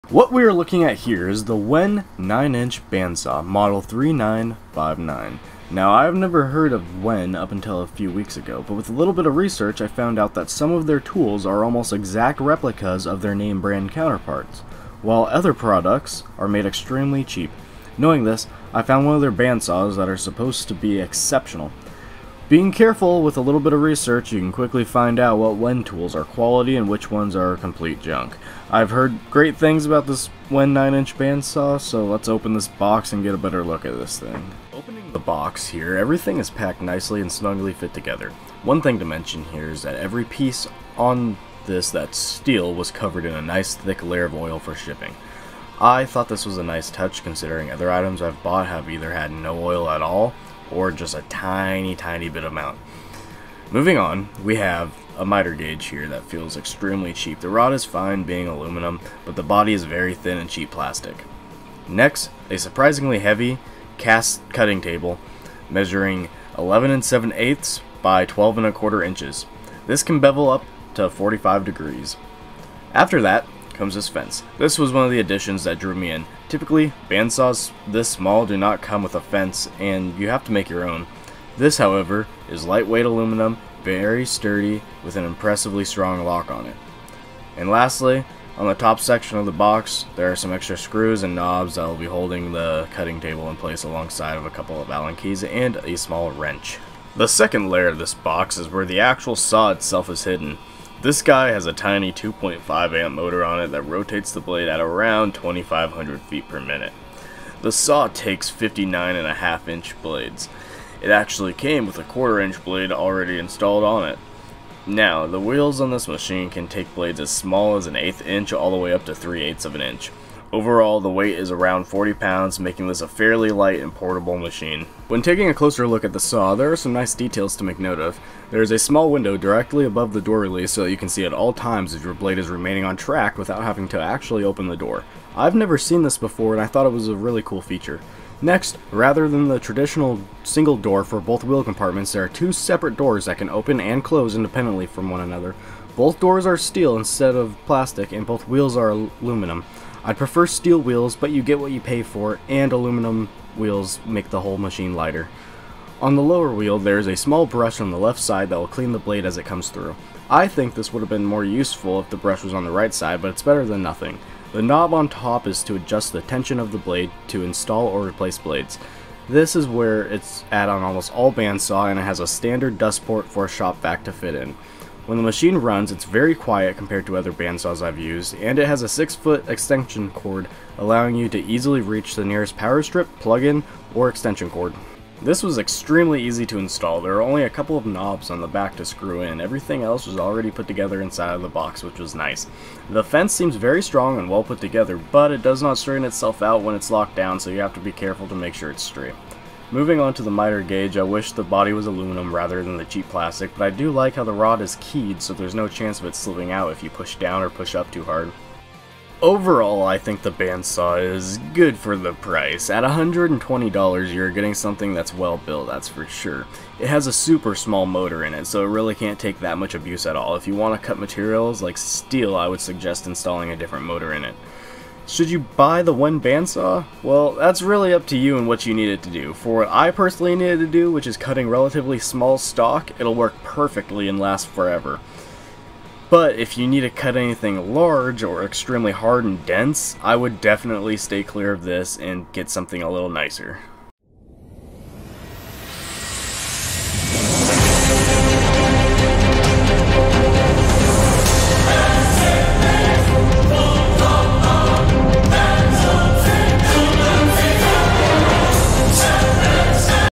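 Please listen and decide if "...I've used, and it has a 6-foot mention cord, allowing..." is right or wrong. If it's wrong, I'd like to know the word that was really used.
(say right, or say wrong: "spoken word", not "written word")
wrong: "extension", not "mention".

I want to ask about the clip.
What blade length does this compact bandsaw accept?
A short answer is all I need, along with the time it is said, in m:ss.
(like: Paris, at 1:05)
59.5 inches, at 1:48.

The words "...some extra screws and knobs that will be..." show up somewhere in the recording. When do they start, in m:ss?
1:30.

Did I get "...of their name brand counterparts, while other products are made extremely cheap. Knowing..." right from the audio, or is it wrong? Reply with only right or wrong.
right.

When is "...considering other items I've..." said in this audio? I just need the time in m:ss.
0:47.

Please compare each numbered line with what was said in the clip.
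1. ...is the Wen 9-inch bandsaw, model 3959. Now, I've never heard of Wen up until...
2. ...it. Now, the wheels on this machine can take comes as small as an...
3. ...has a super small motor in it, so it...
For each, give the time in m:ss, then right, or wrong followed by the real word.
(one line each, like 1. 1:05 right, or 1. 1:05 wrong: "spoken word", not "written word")
1. 0:01 right
2. 1:54 wrong: "blades", not "comes"
3. 3:36 right.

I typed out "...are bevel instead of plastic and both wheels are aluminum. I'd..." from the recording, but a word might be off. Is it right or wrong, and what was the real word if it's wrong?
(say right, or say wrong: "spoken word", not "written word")
wrong: "steel", not "bevel".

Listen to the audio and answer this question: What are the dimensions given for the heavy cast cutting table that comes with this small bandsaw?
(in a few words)
11 7/8 by 12 1/4 inches.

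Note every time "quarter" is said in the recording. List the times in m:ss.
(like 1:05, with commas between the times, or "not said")
1:08, 1:52.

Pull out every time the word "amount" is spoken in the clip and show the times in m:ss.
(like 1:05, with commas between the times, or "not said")
0:52.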